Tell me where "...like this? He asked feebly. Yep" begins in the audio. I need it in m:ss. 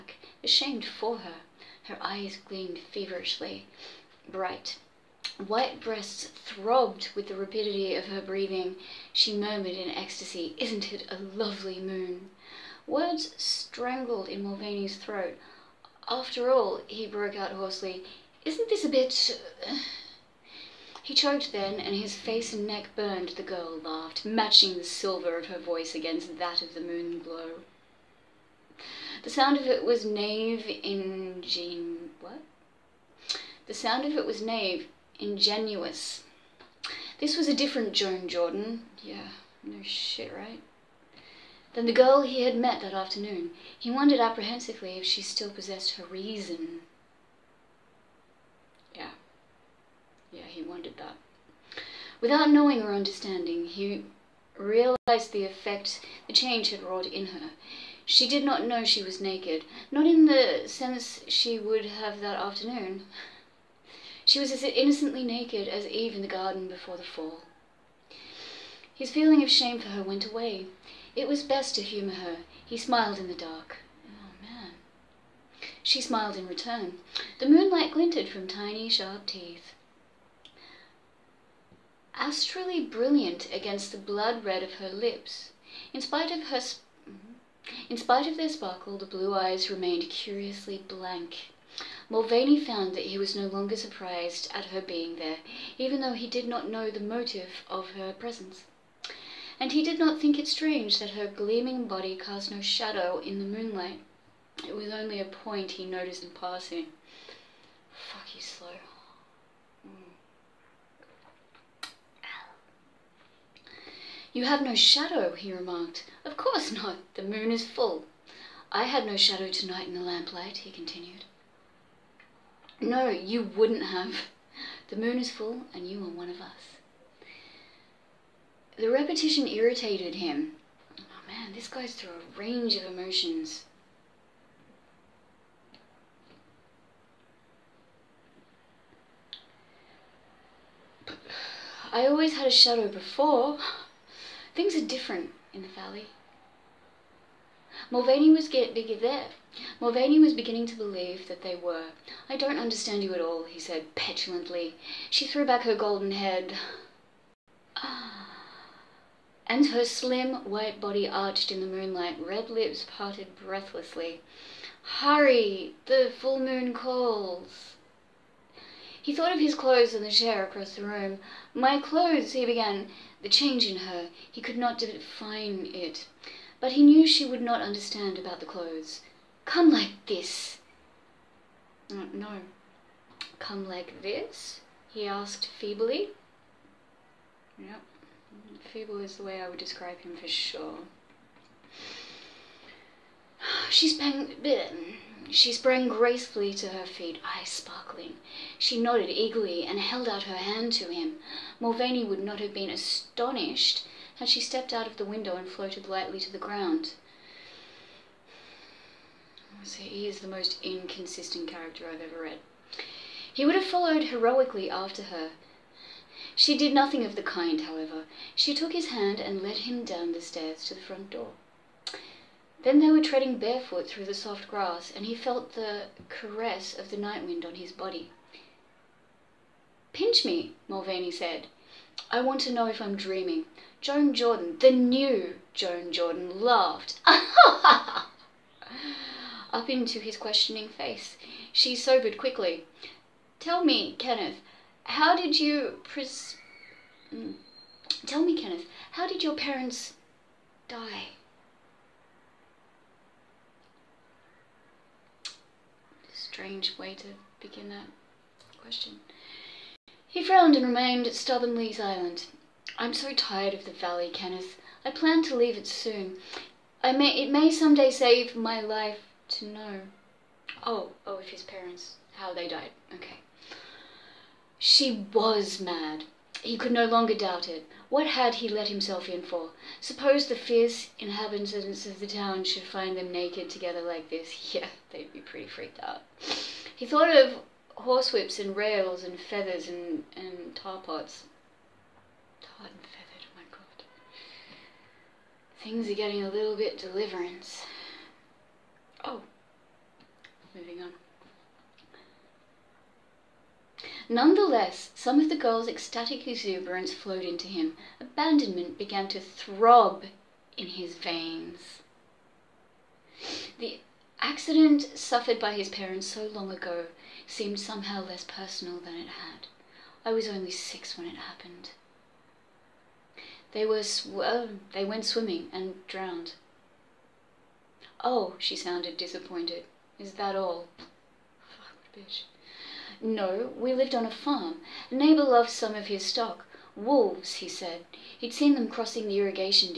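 3:03.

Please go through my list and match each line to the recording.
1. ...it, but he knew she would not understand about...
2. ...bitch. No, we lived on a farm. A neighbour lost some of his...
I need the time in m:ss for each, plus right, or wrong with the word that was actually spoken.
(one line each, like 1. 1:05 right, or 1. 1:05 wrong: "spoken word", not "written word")
1. 2:55 right
2. 5:31 right.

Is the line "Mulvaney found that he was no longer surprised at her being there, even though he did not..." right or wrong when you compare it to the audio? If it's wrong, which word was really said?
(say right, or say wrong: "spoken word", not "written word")
right.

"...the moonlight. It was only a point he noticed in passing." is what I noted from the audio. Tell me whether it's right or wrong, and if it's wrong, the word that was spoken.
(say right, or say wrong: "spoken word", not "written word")
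right.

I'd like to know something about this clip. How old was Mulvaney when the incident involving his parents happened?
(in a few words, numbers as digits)
6.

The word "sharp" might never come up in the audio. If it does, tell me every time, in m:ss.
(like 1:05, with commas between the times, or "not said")
1:18.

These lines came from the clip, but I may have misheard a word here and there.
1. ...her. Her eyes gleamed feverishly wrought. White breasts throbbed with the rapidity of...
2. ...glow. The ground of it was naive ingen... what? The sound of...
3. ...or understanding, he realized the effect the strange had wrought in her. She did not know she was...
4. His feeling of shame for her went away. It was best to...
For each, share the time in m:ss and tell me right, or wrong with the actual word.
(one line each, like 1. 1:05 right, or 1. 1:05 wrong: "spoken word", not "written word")
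1. 0:01 wrong: "bright", not "wrought"
2. 0:27 wrong: "sound", not "ground"
3. 0:52 wrong: "change", not "strange"
4. 1:08 right.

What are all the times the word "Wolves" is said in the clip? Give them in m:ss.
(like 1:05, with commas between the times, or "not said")
5:36.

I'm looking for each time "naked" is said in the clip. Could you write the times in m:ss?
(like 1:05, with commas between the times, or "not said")
0:59, 1:05, 4:43.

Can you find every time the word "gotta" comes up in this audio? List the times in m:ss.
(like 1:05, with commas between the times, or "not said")
not said.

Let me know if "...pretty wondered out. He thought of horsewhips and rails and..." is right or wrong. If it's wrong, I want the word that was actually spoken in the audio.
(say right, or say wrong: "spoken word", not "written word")
wrong: "freaked", not "wondered".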